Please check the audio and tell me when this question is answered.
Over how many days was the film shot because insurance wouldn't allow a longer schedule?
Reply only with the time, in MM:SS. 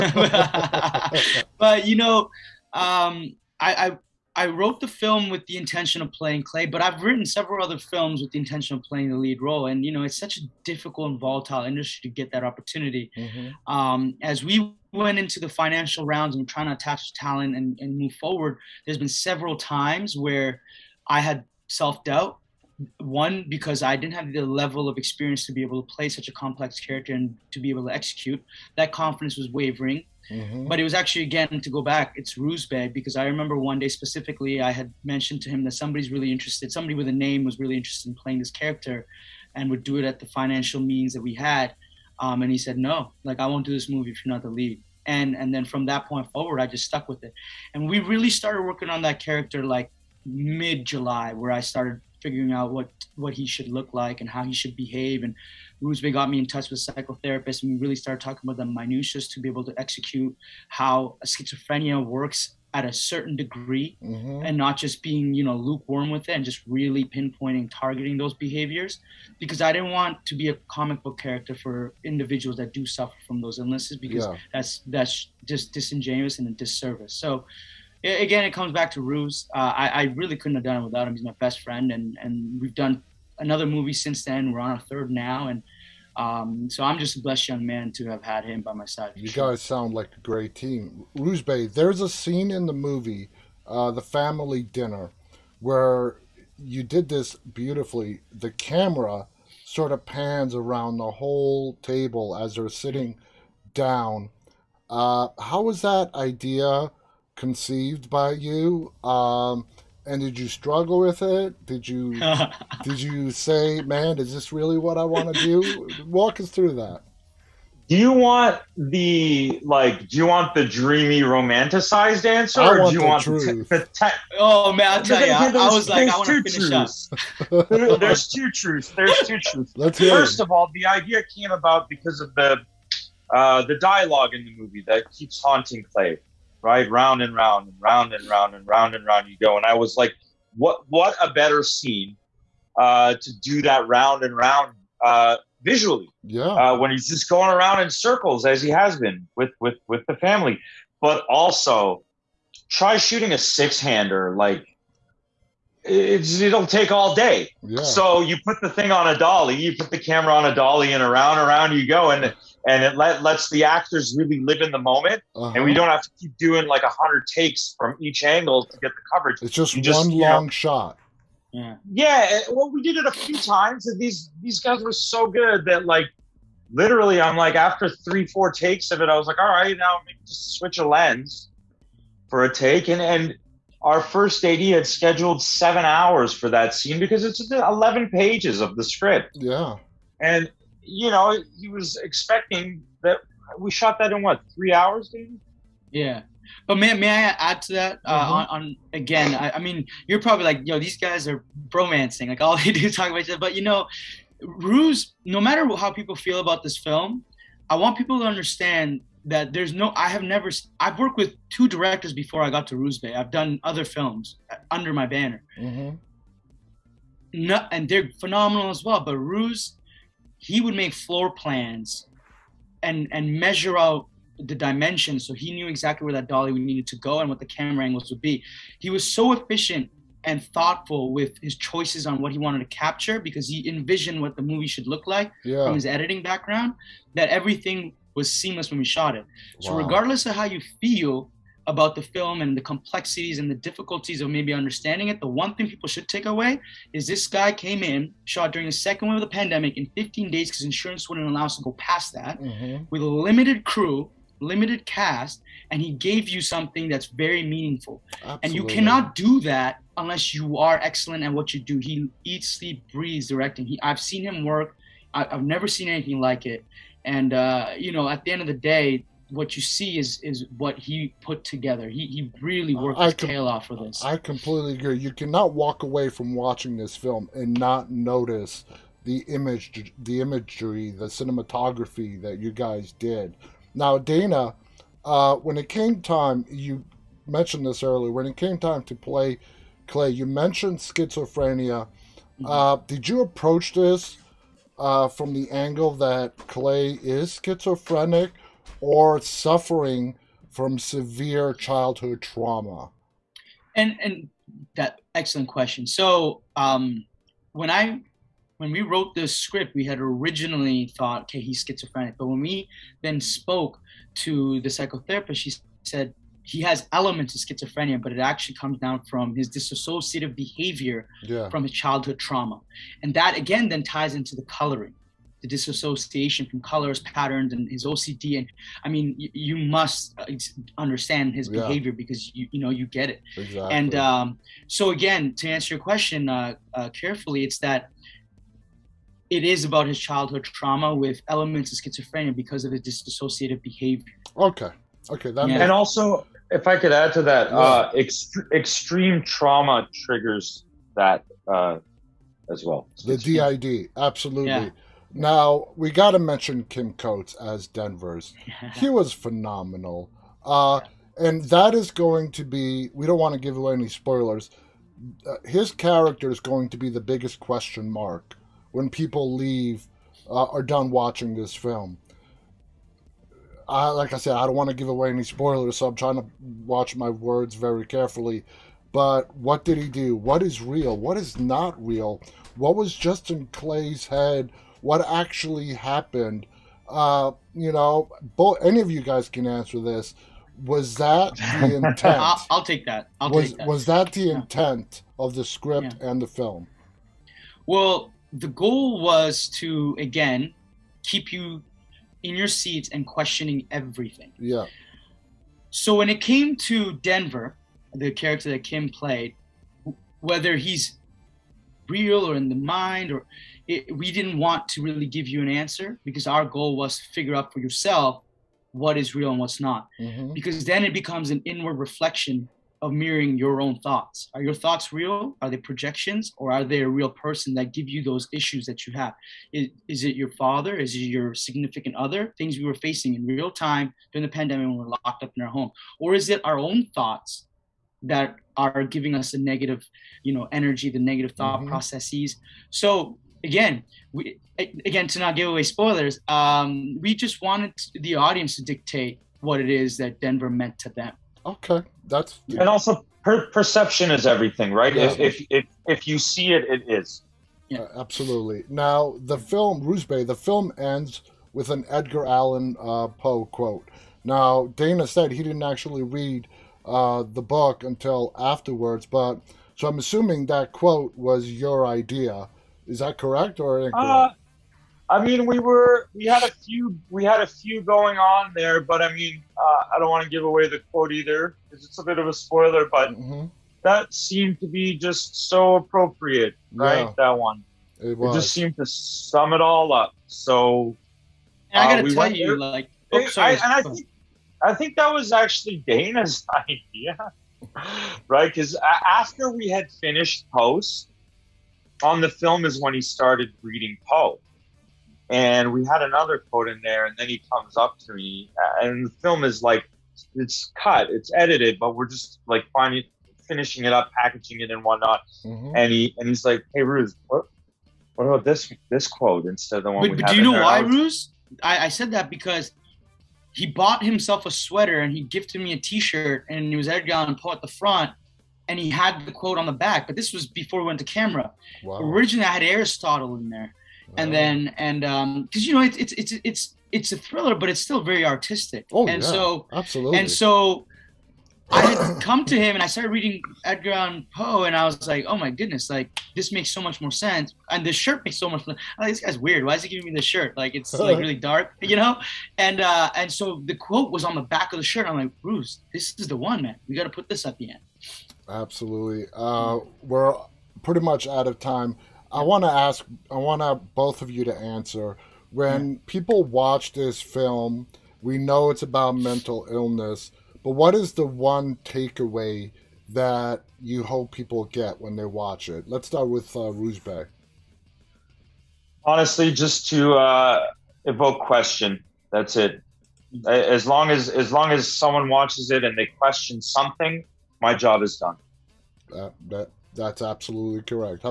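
04:09.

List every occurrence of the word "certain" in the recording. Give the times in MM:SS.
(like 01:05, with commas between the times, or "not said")
01:02.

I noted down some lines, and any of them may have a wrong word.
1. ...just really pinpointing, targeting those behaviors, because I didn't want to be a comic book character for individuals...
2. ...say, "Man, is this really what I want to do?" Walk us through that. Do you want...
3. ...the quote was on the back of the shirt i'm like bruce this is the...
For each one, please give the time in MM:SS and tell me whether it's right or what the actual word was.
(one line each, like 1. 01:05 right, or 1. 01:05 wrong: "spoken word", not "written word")
1. 01:06 right
2. 01:53 right
3. 09:13 right.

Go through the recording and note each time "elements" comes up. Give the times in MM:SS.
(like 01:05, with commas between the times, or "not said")
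05:16, 05:41.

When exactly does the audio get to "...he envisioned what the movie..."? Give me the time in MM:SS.
03:53.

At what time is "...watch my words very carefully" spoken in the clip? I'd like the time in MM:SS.
06:16.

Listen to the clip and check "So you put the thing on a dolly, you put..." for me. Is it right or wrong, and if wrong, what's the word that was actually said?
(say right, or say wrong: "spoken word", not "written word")
right.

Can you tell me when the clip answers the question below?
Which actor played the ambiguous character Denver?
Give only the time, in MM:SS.
05:56.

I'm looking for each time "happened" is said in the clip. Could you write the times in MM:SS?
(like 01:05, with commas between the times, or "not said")
06:25.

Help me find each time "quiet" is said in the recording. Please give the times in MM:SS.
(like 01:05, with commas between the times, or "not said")
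not said.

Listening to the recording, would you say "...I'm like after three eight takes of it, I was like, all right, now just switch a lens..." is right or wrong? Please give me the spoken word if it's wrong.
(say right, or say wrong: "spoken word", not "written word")
wrong: "four", not "eight".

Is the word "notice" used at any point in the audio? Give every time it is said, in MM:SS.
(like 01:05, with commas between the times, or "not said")
04:37.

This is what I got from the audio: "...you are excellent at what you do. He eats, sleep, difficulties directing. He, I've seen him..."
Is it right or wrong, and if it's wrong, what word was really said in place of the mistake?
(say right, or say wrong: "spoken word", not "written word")
wrong: "breathes", not "difficulties".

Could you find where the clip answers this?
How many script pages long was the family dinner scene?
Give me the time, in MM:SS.
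03:07.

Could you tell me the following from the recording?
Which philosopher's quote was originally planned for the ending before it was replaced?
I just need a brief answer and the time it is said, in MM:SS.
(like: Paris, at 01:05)
Aristotle, at 08:52.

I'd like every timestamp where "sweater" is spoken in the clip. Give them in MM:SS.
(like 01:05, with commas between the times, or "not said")
08:44.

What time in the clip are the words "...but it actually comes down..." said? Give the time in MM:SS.
05:18.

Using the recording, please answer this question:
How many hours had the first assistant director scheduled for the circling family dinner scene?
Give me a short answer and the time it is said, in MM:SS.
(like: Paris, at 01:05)
7, at 03:05.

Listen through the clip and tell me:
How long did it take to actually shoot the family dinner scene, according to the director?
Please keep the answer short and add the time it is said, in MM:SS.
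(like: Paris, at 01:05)
3 hours, at 03:14.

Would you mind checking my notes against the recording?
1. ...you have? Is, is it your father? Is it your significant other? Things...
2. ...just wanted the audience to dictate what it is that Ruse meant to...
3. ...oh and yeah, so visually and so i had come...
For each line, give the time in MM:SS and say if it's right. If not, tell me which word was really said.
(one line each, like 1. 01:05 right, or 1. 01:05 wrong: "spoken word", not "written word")
1. 07:08 right
2. 07:27 wrong: "Denver", not "Ruse"
3. 08:58 wrong: "absolutely", not "visually".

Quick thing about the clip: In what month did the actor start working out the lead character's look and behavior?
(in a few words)
July.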